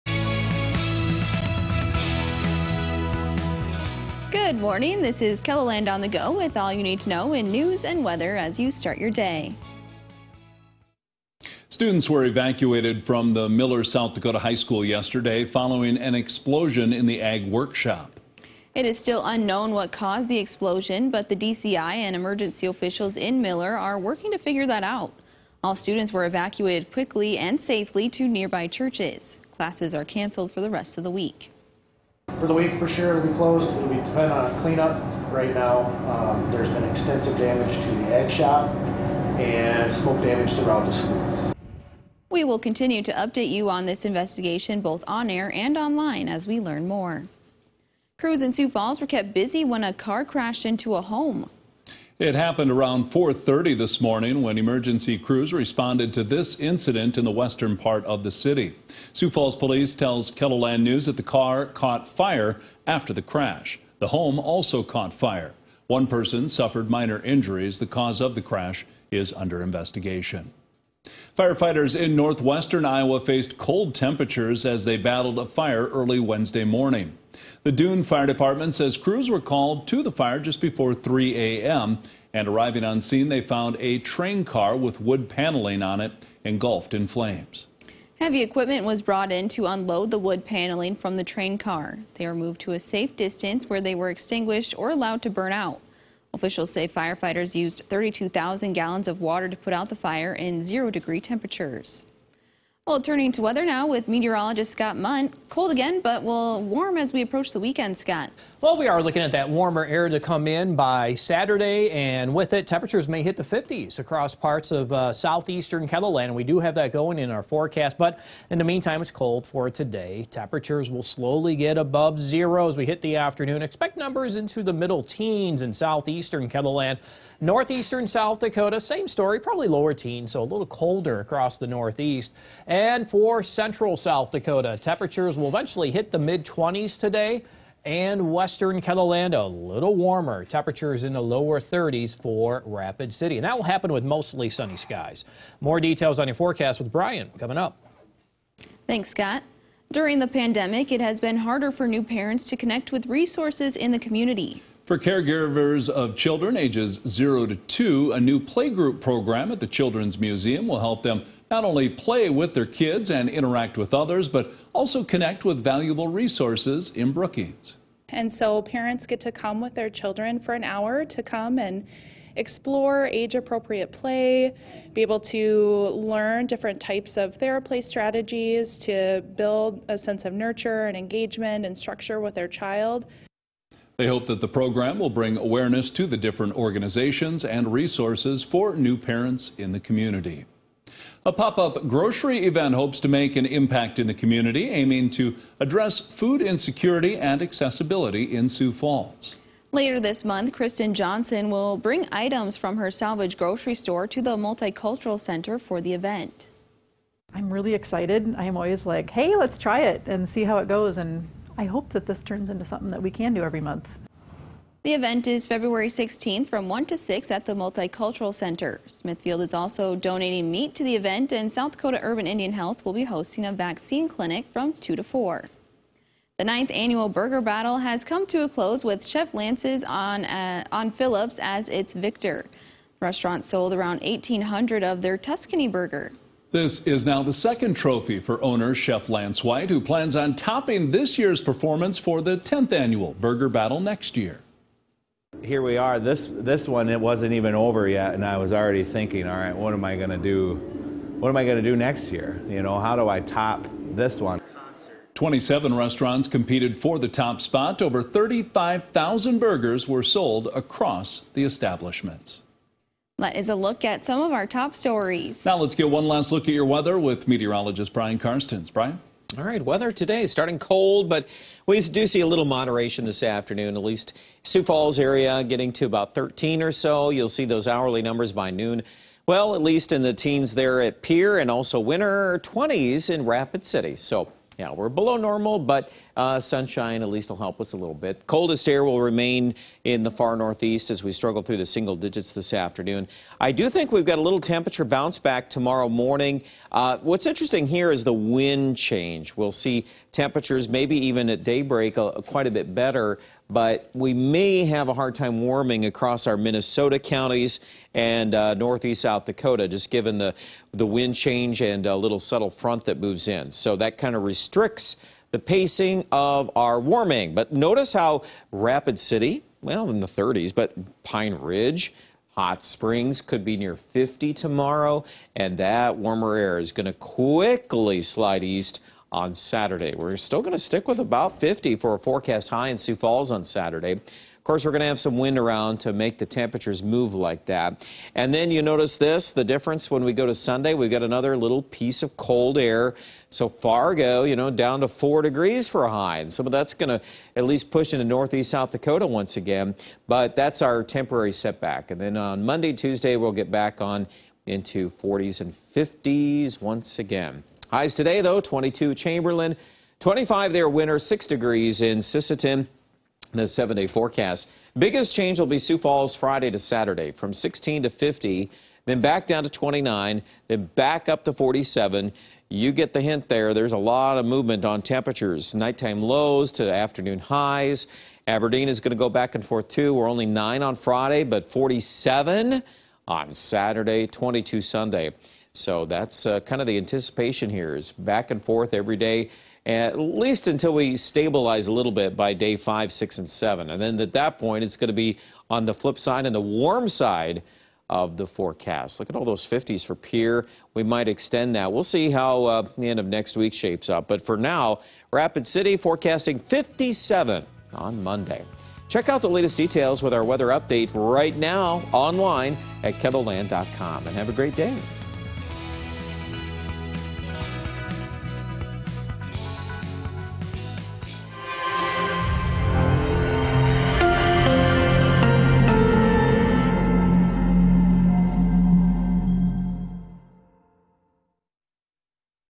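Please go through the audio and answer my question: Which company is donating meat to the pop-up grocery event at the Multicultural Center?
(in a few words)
Smithfield.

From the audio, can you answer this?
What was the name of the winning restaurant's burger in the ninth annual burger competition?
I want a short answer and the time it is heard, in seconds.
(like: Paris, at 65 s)
Tuscany burger, at 235 s.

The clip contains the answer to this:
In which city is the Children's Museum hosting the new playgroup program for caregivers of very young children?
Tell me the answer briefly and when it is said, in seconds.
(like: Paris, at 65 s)
Brookings, at 167 s.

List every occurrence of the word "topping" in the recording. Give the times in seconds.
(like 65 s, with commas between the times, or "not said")
240 s.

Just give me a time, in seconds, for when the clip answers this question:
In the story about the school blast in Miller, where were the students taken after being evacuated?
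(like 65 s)
28 s.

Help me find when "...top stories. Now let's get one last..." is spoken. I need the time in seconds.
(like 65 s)
264 s.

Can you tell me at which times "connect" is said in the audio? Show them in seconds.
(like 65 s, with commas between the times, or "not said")
152 s, 165 s.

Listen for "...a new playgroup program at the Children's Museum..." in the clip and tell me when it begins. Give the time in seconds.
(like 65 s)
158 s.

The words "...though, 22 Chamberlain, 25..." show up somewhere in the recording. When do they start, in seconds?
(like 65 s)
358 s.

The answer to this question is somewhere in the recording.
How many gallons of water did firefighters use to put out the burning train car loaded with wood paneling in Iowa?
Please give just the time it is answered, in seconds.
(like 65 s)
97 s.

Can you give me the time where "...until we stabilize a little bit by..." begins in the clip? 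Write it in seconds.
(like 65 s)
390 s.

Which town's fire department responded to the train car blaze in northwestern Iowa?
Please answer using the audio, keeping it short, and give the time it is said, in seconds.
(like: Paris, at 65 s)
Doon, at 77 s.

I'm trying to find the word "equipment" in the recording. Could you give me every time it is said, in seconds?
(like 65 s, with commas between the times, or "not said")
88 s.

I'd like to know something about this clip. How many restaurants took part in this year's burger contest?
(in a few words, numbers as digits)
27.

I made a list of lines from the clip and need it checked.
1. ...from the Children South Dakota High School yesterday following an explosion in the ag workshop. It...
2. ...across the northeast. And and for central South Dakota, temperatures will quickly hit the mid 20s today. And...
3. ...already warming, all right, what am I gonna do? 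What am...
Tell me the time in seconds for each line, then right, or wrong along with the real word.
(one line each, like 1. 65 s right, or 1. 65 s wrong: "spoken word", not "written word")
1. 13 s wrong: "Miller", not "Children"
2. 131 s wrong: "eventually", not "quickly"
3. 248 s wrong: "thinking", not "warming".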